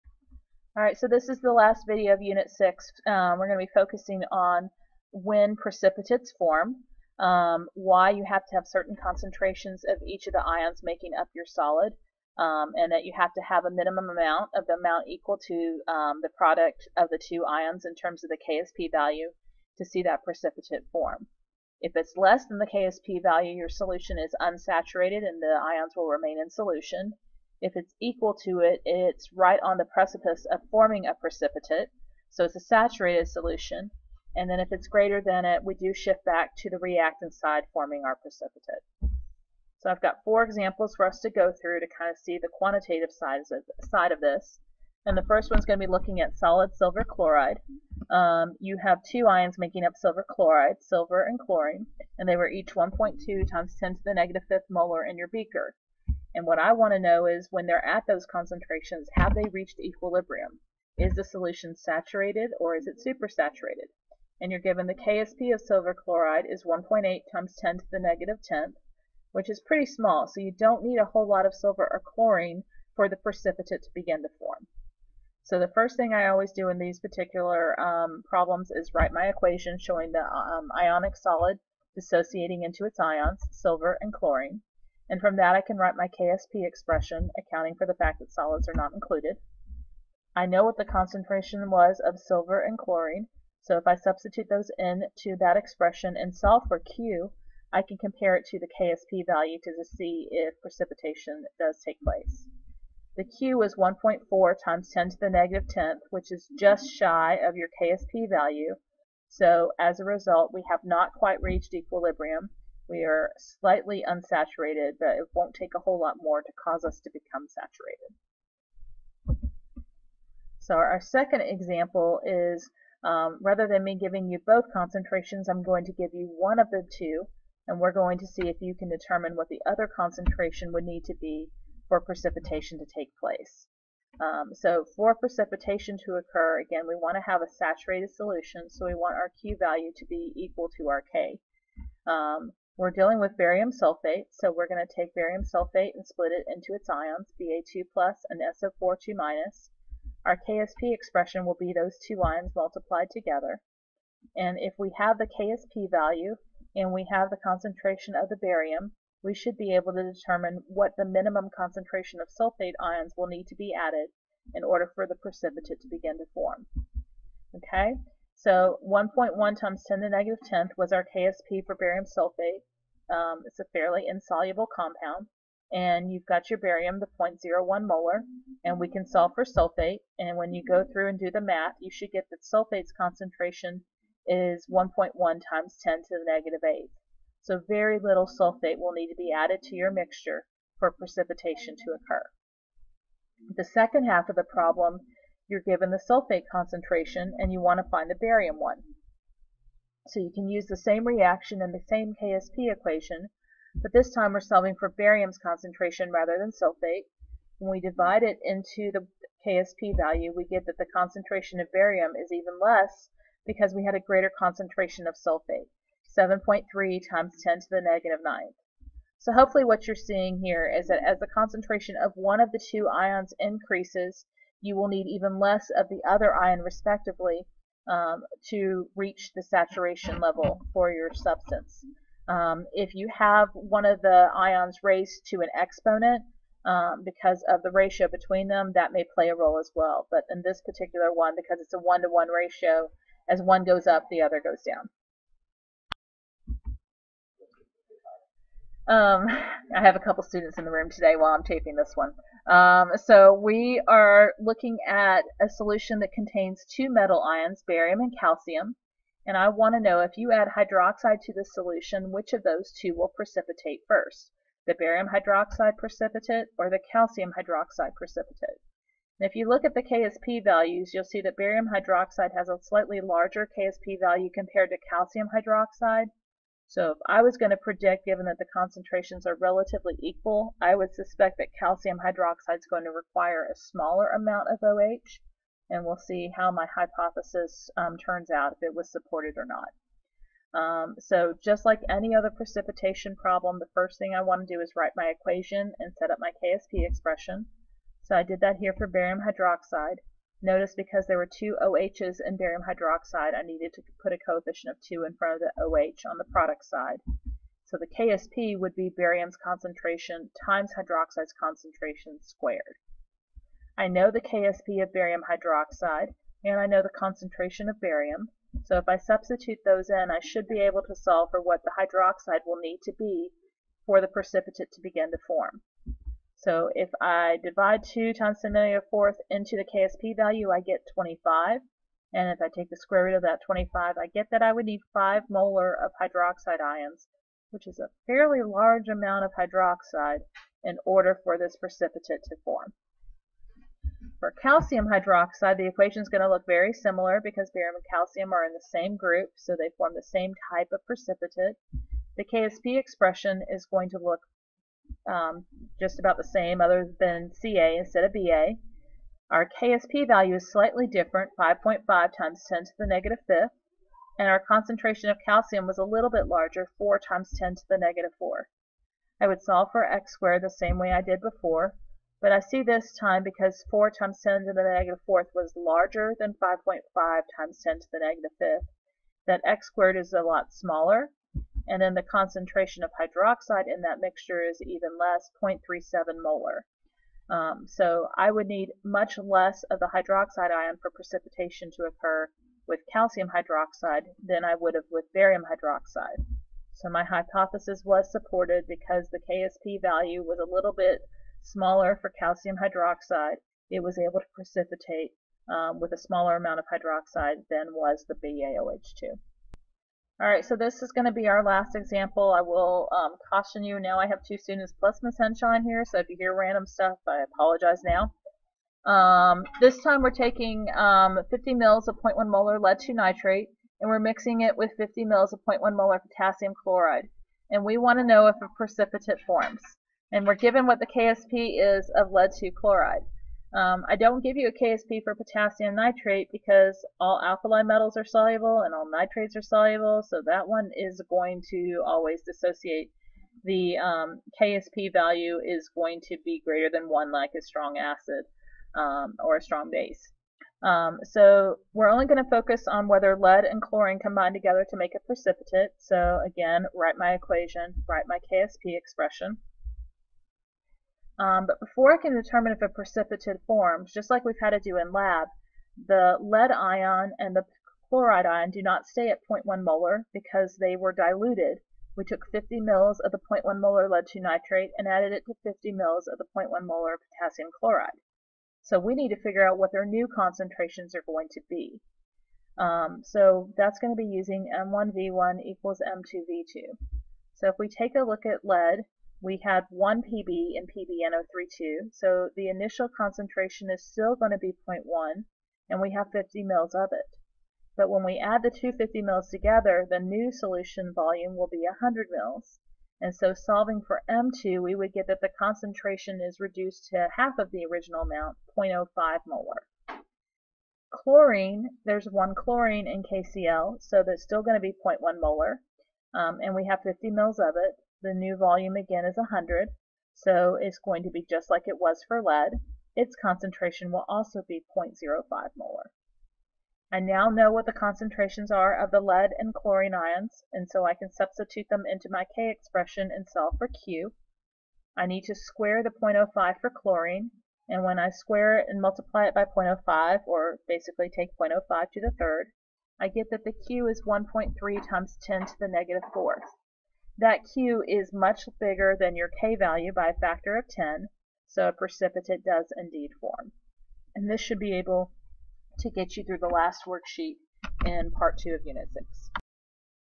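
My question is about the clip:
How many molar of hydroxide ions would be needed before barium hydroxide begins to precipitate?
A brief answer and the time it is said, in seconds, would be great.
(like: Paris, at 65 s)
5 molar, at 334 s.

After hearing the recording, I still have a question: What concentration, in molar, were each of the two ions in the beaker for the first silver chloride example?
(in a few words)
1.2 x 10^-5.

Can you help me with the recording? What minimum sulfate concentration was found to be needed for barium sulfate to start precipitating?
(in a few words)
1.1 x 10^-8.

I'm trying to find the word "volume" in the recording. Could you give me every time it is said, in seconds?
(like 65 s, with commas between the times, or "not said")
500 s, 518 s.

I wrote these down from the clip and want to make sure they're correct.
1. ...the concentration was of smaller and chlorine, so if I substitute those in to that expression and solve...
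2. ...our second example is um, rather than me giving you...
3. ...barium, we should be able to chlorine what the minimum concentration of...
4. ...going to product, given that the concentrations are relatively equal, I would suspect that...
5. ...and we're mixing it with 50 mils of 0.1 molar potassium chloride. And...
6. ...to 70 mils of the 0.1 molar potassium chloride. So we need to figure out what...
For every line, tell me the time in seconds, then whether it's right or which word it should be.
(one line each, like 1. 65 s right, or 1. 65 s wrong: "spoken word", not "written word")
1. 90 s wrong: "silver", not "smaller"
2. 120 s right
3. 158 s wrong: "determine", not "chlorine"
4. 277 s wrong: "predict", not "product"
5. 423 s right
6. 475 s wrong: "50", not "70".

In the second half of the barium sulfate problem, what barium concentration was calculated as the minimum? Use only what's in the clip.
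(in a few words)
7.3 x 10^-9.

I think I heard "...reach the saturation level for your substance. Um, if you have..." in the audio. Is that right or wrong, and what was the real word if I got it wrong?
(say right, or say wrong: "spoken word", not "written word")
right.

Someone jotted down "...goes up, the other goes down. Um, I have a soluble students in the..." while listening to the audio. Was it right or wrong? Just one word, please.
wrong.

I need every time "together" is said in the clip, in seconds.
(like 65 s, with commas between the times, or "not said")
153 s, 454 s, 499 s.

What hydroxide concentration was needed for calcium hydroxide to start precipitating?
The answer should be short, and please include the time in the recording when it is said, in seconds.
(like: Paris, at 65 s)
0.37 molar, at 385 s.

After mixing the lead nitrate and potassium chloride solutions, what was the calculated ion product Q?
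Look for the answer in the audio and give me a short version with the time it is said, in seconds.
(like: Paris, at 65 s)
1.3 x 10^-4, at 544 s.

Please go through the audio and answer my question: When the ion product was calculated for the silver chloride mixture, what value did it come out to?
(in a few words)
1.4 x 10^-10.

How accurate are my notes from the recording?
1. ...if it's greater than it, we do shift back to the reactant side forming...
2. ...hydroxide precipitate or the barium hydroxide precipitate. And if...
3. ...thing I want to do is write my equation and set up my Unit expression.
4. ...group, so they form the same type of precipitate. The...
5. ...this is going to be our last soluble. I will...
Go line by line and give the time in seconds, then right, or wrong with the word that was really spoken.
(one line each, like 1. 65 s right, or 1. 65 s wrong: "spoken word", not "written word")
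1. 34 s right
2. 265 s wrong: "calcium", not "barium"
3. 293 s wrong: "KSP", not "Unit"
4. 348 s right
5. 410 s wrong: "example", not "soluble".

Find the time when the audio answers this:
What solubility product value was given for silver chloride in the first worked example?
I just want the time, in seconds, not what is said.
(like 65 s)
66 s.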